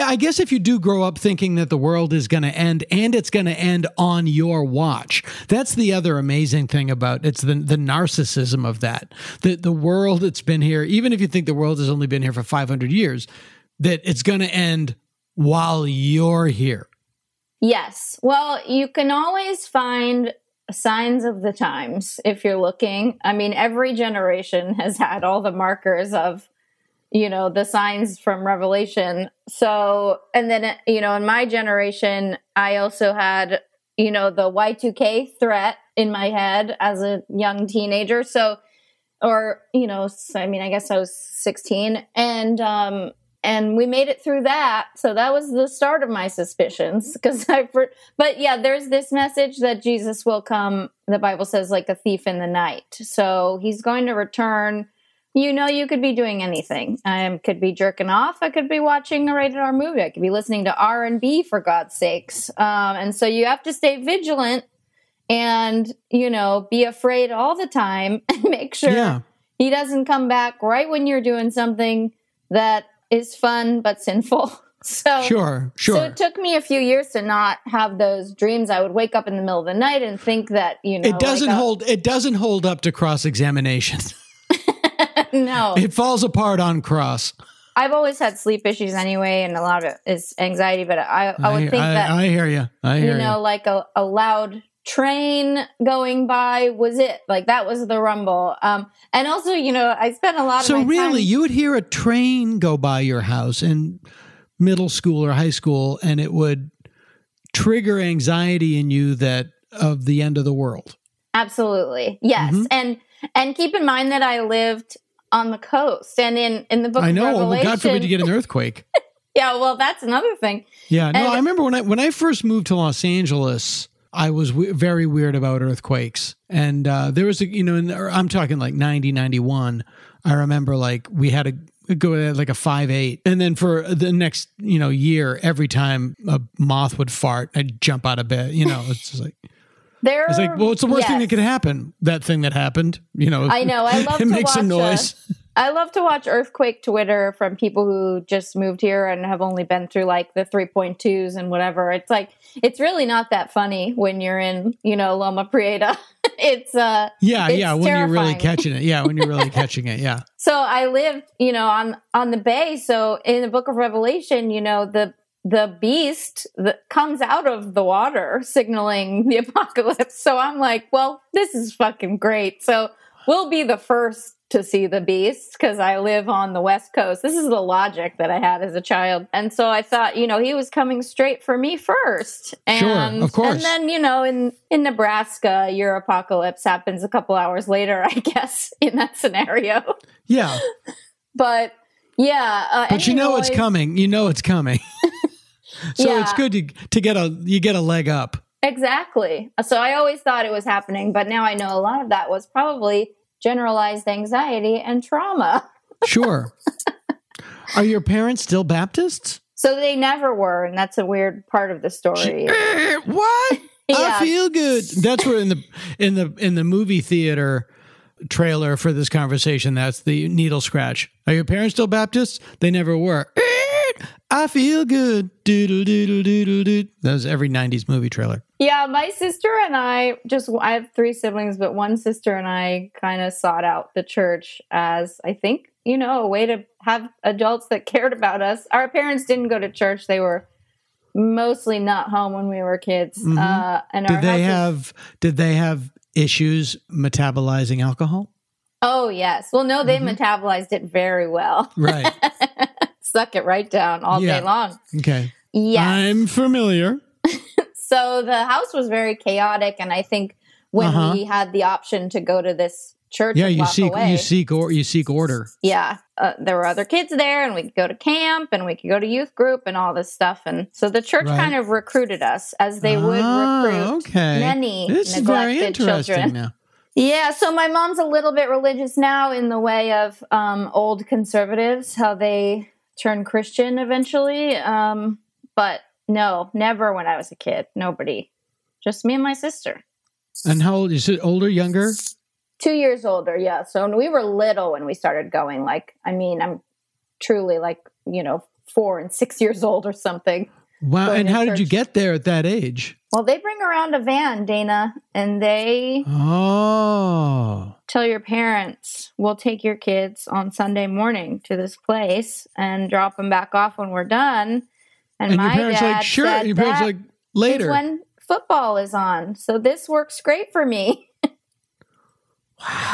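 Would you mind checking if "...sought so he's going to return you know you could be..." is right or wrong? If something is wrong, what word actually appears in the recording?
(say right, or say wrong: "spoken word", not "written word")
wrong: "night", not "sought".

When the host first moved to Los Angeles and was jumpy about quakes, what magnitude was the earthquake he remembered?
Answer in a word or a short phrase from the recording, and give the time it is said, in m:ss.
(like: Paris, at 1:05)
5.8, at 2:12.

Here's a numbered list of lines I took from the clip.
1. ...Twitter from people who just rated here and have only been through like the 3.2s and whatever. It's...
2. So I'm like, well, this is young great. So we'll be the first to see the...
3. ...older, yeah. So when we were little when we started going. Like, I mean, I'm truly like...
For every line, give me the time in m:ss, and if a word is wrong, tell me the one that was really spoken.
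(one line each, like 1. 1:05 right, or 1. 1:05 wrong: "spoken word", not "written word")
1. 2:26 wrong: "moved", not "rated"
2. 2:50 wrong: "fucking", not "young"
3. 4:53 right.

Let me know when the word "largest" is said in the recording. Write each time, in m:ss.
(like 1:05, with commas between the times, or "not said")
not said.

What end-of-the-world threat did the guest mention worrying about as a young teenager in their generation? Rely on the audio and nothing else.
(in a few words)
Y2K.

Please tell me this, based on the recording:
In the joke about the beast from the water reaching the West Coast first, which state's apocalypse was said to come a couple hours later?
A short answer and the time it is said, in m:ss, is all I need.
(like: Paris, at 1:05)
Nebraska, at 3:04.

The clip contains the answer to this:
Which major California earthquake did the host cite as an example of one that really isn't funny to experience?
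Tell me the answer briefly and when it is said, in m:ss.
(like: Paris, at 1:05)
Loma Prieta, at 2:35.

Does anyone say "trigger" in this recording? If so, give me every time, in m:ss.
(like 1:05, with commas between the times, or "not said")
1:47.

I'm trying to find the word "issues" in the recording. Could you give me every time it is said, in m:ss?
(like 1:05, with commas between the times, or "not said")
1:28, 4:06.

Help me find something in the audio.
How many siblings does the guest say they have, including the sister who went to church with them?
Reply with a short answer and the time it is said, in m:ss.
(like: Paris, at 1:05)
3, at 3:50.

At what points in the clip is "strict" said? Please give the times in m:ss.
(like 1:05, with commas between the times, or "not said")
not said.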